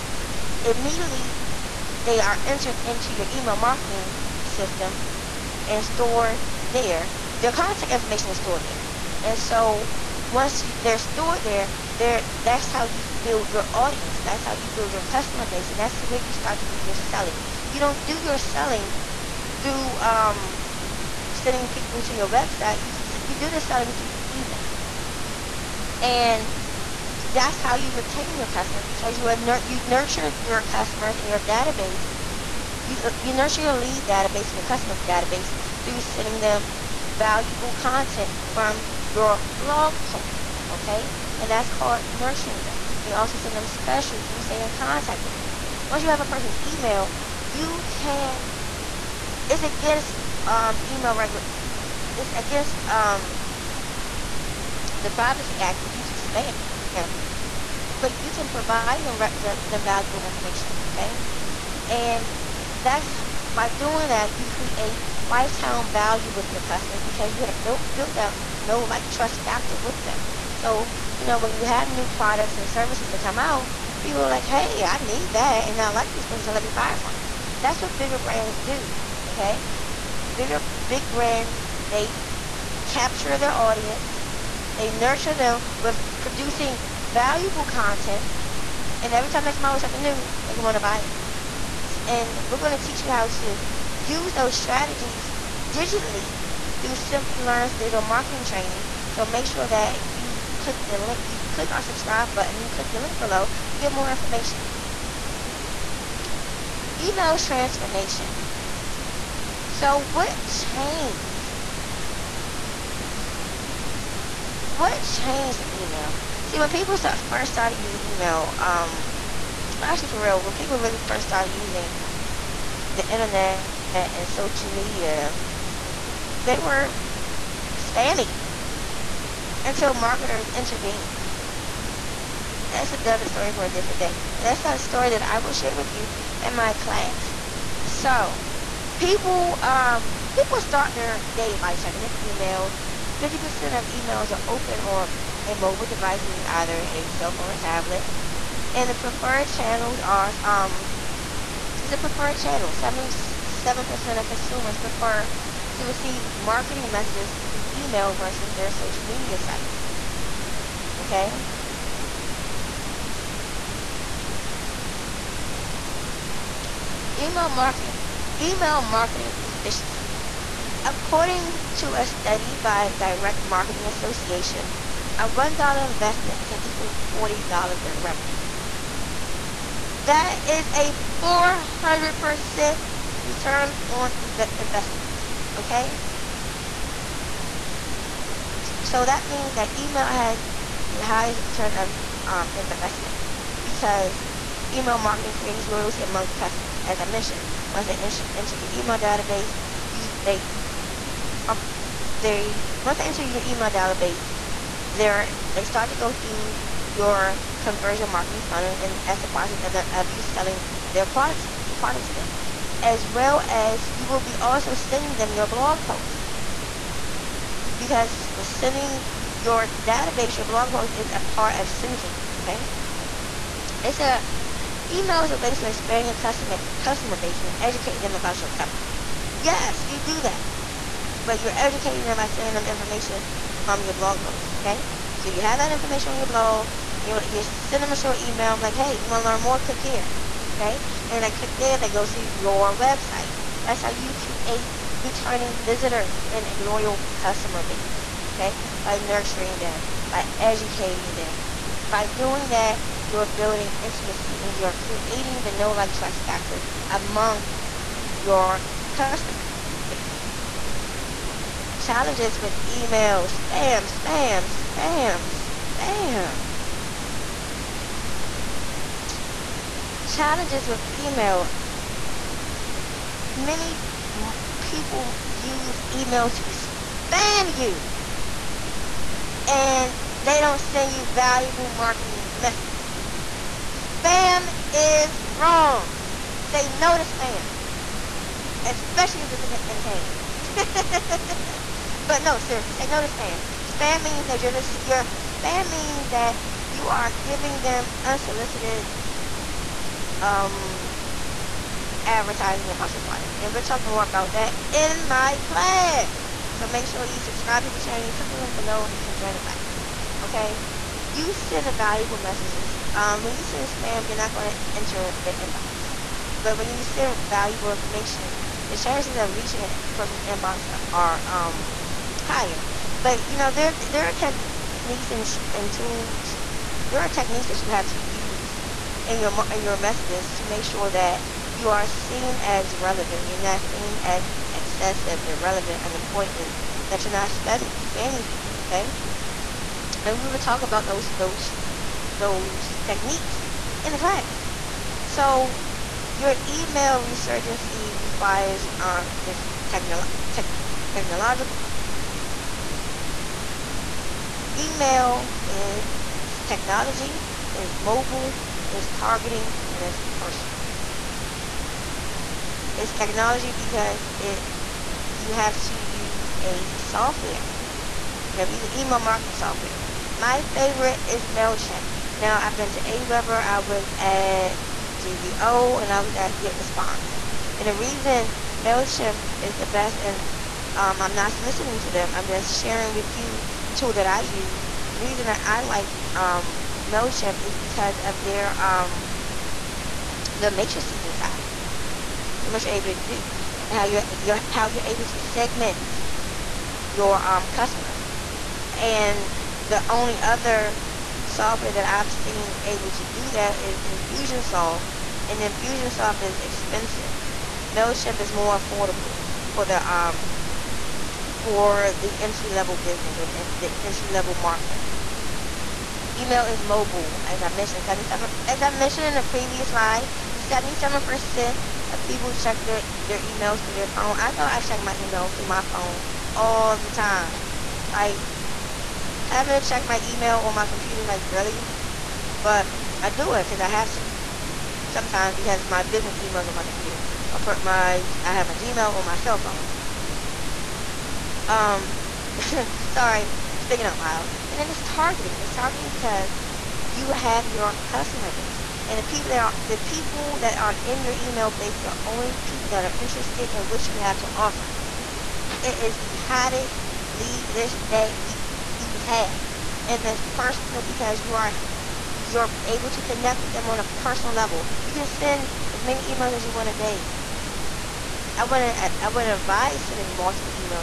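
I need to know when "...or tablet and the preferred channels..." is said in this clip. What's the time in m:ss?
2:27.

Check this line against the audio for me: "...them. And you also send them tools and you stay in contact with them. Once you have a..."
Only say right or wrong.
wrong.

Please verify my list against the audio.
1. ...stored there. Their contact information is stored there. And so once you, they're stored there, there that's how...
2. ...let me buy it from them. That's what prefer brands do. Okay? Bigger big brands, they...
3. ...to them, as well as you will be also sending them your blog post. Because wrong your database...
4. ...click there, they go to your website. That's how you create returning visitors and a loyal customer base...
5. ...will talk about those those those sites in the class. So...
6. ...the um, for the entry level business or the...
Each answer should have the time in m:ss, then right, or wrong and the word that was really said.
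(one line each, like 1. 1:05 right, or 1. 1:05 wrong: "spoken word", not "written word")
1. 0:05 right
2. 1:16 wrong: "bigger", not "prefer"
3. 3:32 wrong: "sending", not "wrong"
4. 4:01 right
5. 5:40 wrong: "techniques", not "sites"
6. 6:49 right.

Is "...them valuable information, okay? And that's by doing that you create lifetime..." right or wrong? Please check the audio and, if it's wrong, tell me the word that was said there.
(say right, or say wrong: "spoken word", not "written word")
right.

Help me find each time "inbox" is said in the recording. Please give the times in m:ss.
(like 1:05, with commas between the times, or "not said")
5:15, 5:20.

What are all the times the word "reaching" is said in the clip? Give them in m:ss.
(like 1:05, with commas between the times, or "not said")
5:19.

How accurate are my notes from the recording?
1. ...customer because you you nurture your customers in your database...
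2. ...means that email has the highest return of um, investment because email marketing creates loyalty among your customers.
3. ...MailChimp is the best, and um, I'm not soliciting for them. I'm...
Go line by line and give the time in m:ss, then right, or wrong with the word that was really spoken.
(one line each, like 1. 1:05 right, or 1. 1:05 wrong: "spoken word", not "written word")
1. 0:28 right
2. 3:09 right
3. 6:18 right.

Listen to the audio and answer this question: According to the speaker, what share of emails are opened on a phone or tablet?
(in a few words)
50%.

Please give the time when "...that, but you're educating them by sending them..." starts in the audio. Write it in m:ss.
3:50.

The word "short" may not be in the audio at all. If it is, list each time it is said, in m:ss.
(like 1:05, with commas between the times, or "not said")
3:57.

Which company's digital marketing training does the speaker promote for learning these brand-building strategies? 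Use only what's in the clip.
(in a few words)
Simplilearn.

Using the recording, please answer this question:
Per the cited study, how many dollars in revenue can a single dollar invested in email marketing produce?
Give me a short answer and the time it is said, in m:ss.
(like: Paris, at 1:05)
$40, at 2:57.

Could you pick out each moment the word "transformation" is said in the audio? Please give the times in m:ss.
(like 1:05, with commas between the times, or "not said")
1:47.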